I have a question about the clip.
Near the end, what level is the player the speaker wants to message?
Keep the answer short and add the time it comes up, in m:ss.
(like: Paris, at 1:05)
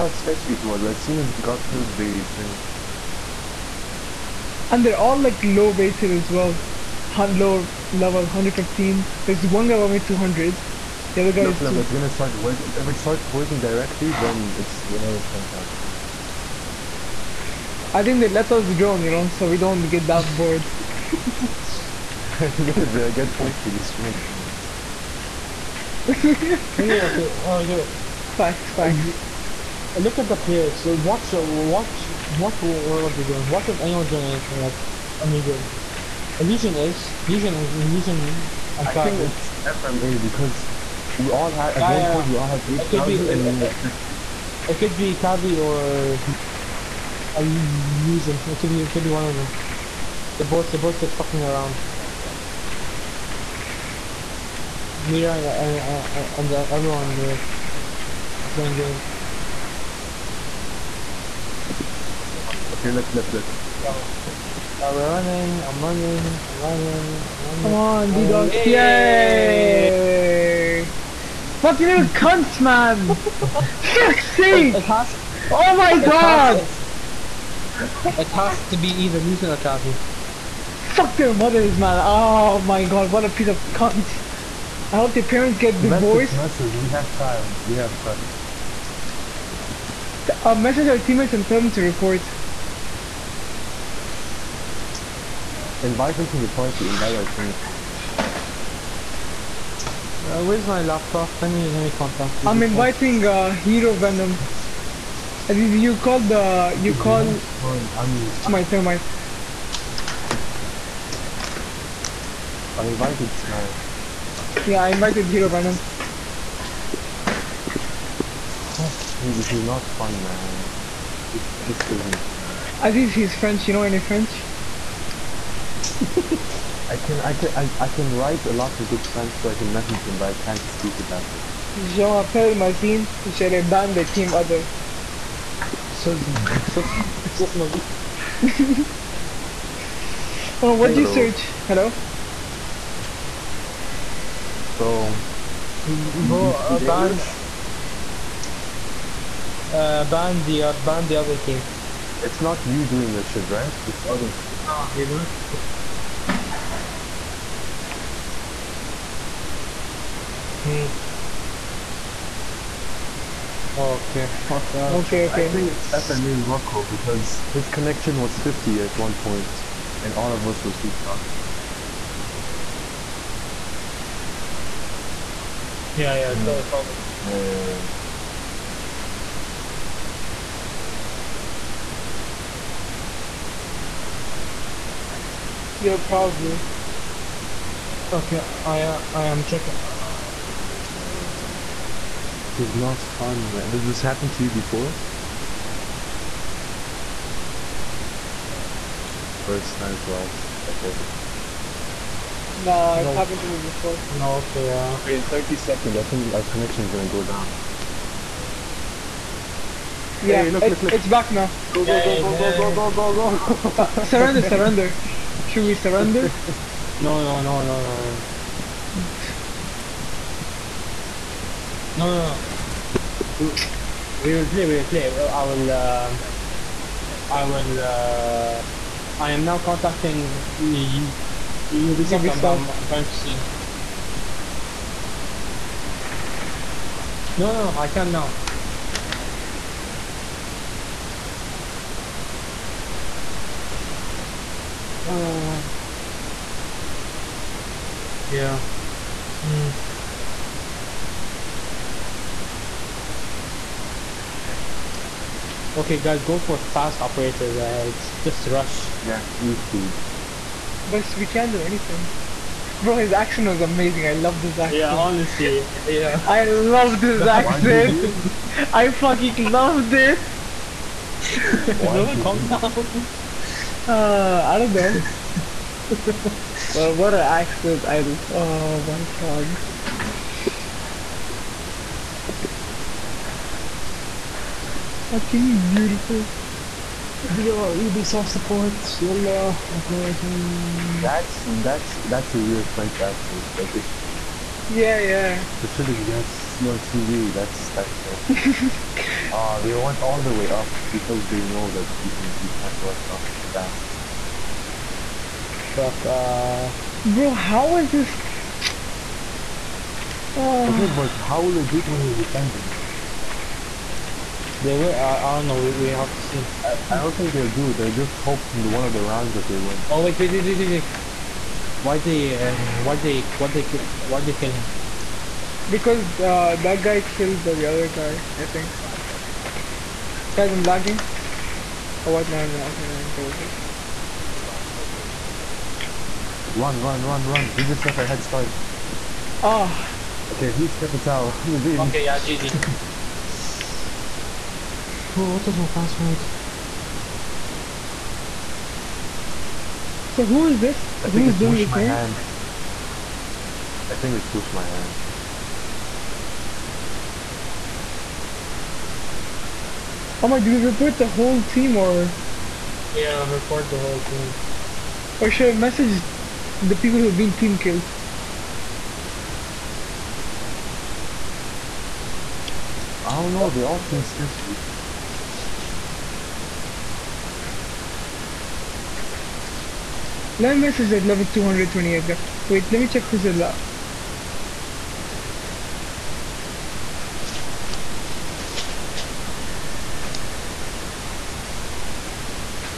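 228, at 6:21.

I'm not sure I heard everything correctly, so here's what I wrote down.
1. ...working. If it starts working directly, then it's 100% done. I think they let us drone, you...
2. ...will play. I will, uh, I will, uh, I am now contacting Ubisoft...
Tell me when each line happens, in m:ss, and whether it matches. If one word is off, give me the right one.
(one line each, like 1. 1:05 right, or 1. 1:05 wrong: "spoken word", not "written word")
1. 0:12 right
2. 3:44 right.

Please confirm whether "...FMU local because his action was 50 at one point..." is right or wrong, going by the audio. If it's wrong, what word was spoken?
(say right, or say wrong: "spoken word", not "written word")
wrong: "connection", not "action".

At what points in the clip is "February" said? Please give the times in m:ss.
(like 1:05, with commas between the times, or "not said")
not said.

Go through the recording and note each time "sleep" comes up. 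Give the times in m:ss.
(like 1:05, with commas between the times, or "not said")
not said.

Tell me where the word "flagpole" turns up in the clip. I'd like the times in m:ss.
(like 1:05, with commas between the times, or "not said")
not said.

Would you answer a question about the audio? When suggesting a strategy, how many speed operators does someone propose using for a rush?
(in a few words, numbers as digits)
3.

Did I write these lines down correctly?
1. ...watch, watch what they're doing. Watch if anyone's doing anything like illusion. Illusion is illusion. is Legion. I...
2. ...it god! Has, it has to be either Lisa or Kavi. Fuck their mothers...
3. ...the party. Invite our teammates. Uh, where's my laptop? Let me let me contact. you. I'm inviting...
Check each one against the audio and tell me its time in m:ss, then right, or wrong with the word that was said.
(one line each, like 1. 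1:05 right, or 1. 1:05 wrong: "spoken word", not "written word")
1. 0:31 right
2. 1:15 right
3. 1:36 right.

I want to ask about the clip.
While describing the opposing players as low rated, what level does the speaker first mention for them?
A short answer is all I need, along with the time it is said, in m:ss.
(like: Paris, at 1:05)
115, at 0:07.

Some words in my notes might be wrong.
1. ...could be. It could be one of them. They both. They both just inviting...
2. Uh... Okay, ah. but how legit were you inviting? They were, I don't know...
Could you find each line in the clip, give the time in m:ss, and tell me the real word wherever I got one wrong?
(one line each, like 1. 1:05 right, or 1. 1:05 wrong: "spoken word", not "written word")
1. 0:48 wrong: "fucking", not "inviting"
2. 5:10 wrong: "defending", not "inviting".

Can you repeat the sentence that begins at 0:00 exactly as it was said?
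As soon as got kills the thing.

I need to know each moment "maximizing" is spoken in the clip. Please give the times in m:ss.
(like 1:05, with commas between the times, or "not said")
not said.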